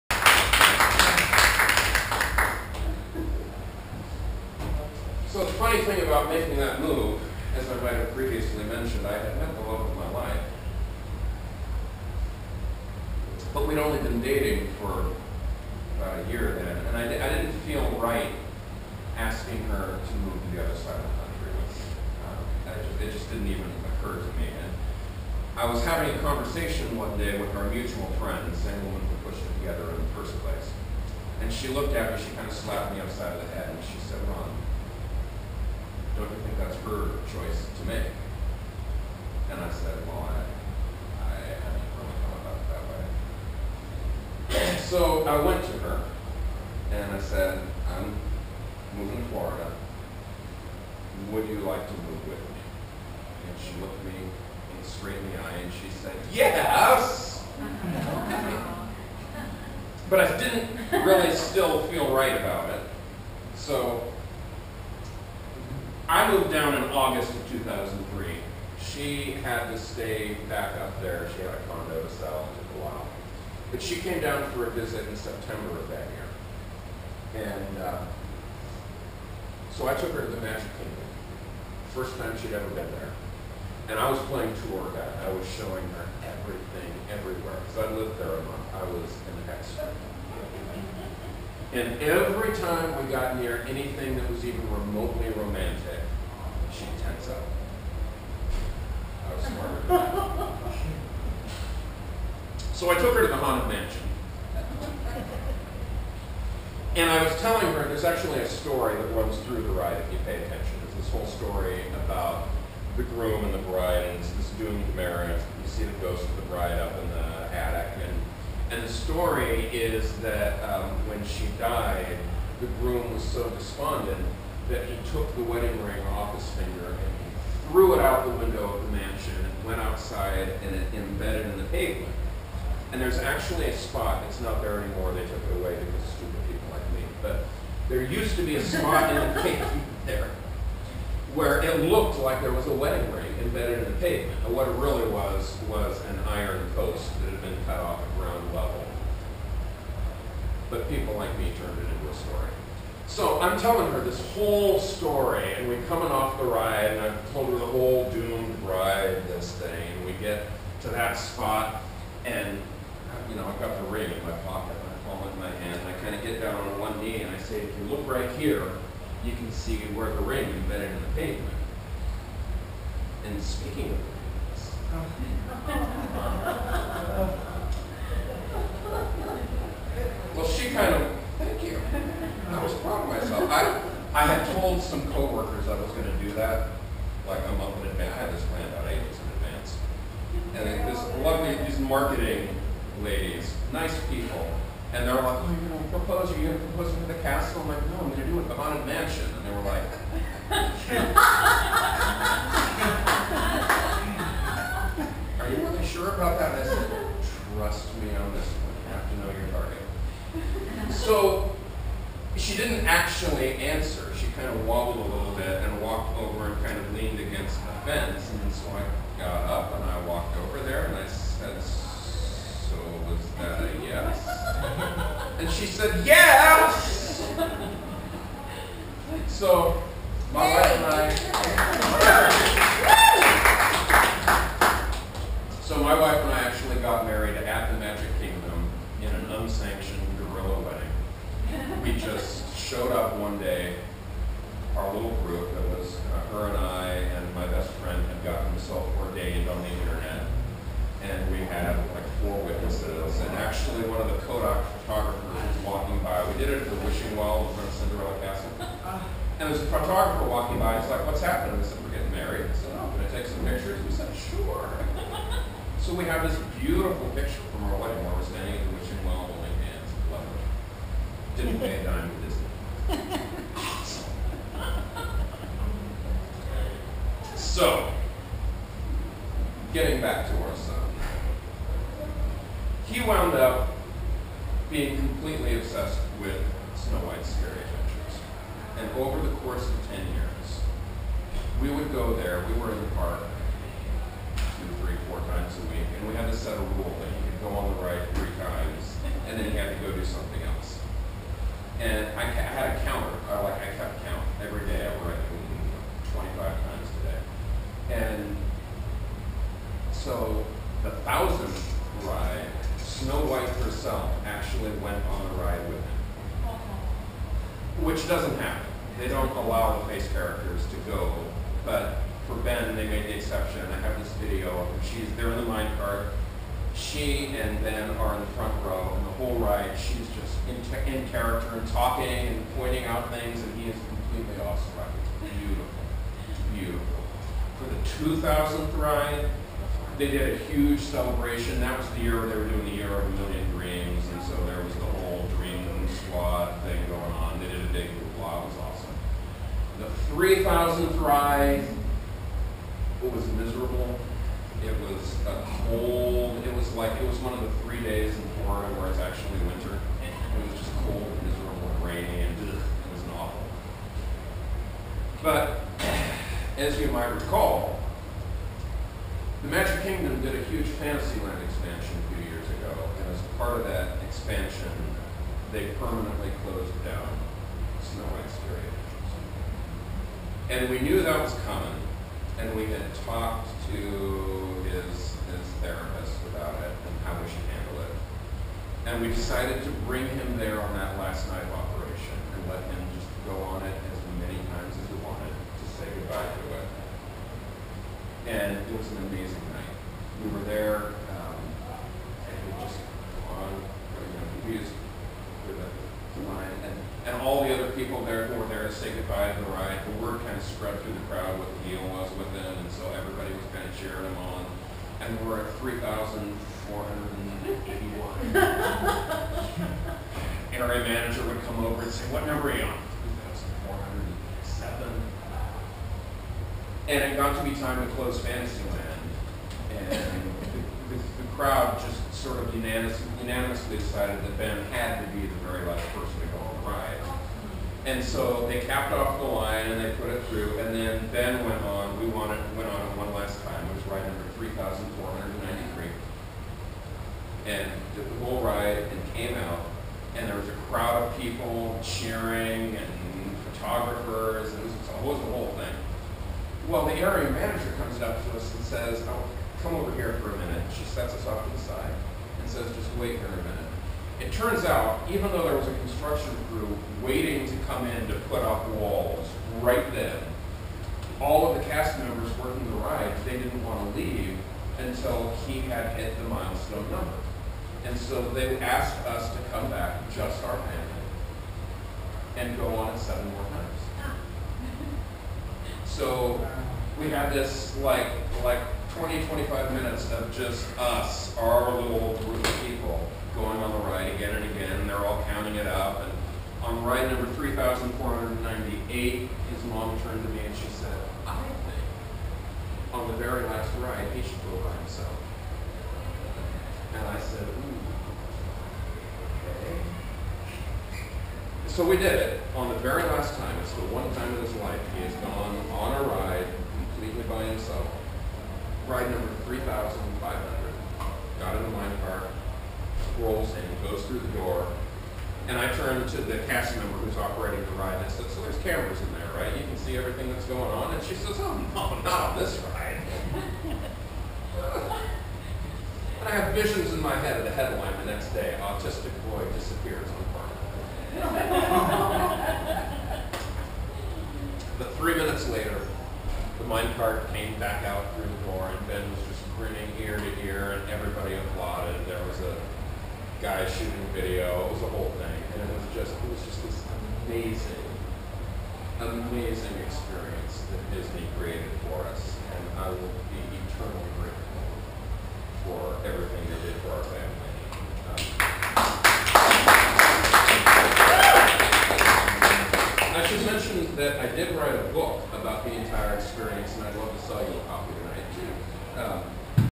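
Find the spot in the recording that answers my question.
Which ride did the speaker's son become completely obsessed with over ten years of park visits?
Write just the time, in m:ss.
4:46.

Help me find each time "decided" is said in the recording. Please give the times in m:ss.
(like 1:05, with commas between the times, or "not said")
6:29, 7:13.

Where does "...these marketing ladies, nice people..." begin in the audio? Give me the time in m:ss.
3:11.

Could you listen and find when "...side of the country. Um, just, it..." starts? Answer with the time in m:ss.
0:20.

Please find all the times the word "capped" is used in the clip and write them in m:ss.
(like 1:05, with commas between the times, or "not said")
7:18.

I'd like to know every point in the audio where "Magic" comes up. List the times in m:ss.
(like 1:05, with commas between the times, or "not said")
1:20, 3:57, 6:09.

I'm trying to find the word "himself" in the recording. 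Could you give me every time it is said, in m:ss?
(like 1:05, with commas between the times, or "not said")
4:08, 8:24, 8:37.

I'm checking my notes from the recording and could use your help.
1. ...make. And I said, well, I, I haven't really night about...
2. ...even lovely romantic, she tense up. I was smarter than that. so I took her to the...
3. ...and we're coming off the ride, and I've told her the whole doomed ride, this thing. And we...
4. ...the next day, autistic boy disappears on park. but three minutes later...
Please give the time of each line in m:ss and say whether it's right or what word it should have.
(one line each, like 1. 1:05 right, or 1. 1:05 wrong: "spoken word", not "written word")
1. 0:37 wrong: "thought", not "night"
2. 1:34 wrong: "remotely", not "lovely"
3. 2:35 right
4. 8:58 right.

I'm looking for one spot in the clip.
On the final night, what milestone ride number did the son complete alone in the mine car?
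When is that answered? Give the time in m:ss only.
8:39.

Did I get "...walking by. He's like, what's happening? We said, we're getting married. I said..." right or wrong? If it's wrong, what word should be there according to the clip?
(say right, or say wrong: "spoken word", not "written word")
right.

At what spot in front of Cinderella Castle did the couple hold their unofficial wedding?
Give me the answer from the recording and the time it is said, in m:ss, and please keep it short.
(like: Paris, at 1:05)
The wishing well, at 4:16.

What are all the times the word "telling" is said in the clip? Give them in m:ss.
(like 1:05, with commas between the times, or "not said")
1:47, 2:33.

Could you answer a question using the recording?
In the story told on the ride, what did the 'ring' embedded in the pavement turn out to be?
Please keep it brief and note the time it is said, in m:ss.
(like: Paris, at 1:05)
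An iron post, at 2:26.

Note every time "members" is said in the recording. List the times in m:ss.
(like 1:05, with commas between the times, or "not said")
7:51, 8:46.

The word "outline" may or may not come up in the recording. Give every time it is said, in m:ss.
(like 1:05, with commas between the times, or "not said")
not said.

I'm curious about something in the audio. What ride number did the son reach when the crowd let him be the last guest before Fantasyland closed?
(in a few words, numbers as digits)
3,493.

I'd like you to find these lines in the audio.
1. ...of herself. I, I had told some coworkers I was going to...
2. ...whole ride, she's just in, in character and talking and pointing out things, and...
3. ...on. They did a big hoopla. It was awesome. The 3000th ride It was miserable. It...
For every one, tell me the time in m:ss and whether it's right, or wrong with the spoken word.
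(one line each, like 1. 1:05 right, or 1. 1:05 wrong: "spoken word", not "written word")
1. 3:03 wrong: "myself", not "herself"
2. 5:29 right
3. 5:47 right.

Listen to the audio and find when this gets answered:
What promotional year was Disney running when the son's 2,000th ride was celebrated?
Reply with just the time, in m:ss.
5:42.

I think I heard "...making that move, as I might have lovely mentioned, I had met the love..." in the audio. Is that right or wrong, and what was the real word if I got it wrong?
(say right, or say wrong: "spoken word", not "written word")
wrong: "previously", not "lovely".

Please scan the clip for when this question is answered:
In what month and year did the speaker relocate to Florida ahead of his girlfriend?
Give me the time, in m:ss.
1:06.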